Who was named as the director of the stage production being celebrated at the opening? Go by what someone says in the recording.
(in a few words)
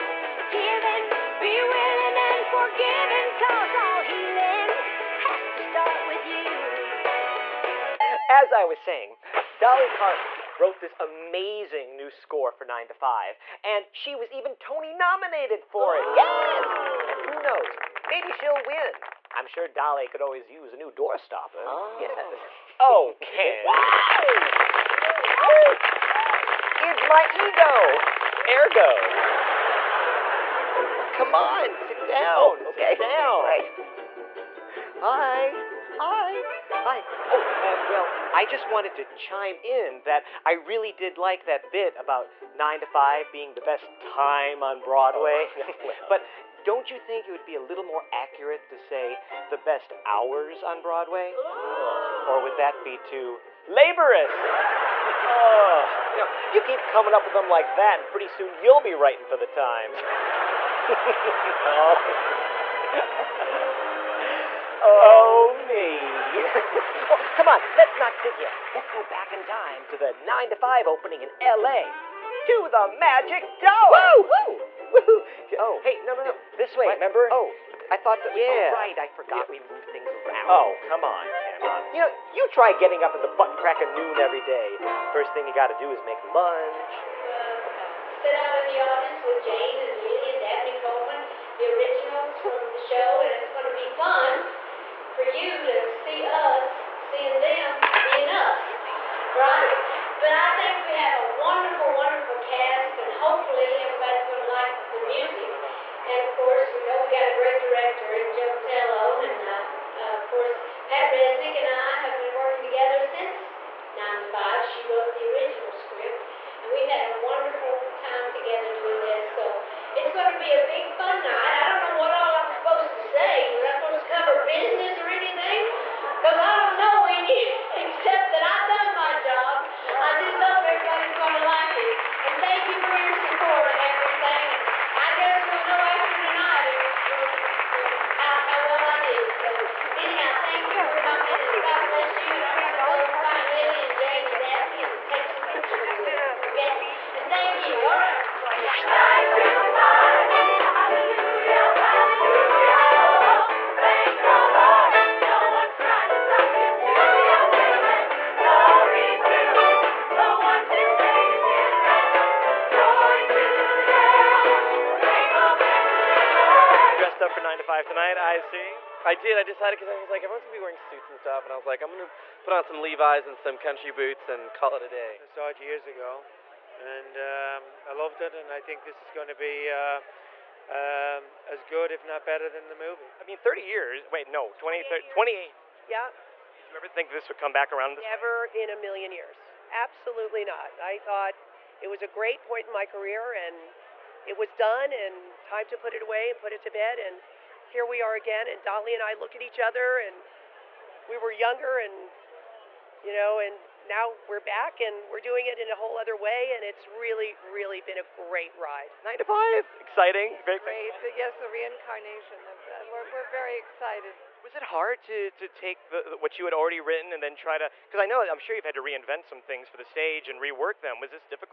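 Joe Mantello.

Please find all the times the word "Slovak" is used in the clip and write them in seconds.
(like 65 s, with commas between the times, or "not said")
not said.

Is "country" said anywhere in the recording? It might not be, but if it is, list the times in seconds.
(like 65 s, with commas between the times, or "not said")
173 s.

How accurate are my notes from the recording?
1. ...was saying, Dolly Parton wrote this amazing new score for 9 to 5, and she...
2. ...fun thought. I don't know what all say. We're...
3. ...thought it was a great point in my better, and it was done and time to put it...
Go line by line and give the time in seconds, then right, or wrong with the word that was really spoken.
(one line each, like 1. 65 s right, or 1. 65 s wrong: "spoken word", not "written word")
1. 8 s right
2. 120 s wrong: "night", not "thought"
3. 190 s wrong: "career", not "better".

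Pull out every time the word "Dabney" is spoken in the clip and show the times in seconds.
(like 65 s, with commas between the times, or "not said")
90 s, 144 s.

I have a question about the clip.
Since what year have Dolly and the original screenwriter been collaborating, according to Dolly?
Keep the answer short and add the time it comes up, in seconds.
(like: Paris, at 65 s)
1995, at 113 s.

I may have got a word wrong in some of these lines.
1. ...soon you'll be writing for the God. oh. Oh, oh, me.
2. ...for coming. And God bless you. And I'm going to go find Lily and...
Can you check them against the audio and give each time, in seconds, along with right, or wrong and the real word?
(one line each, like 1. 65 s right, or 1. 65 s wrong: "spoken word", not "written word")
1. 58 s wrong: "Times", not "God"
2. 140 s right.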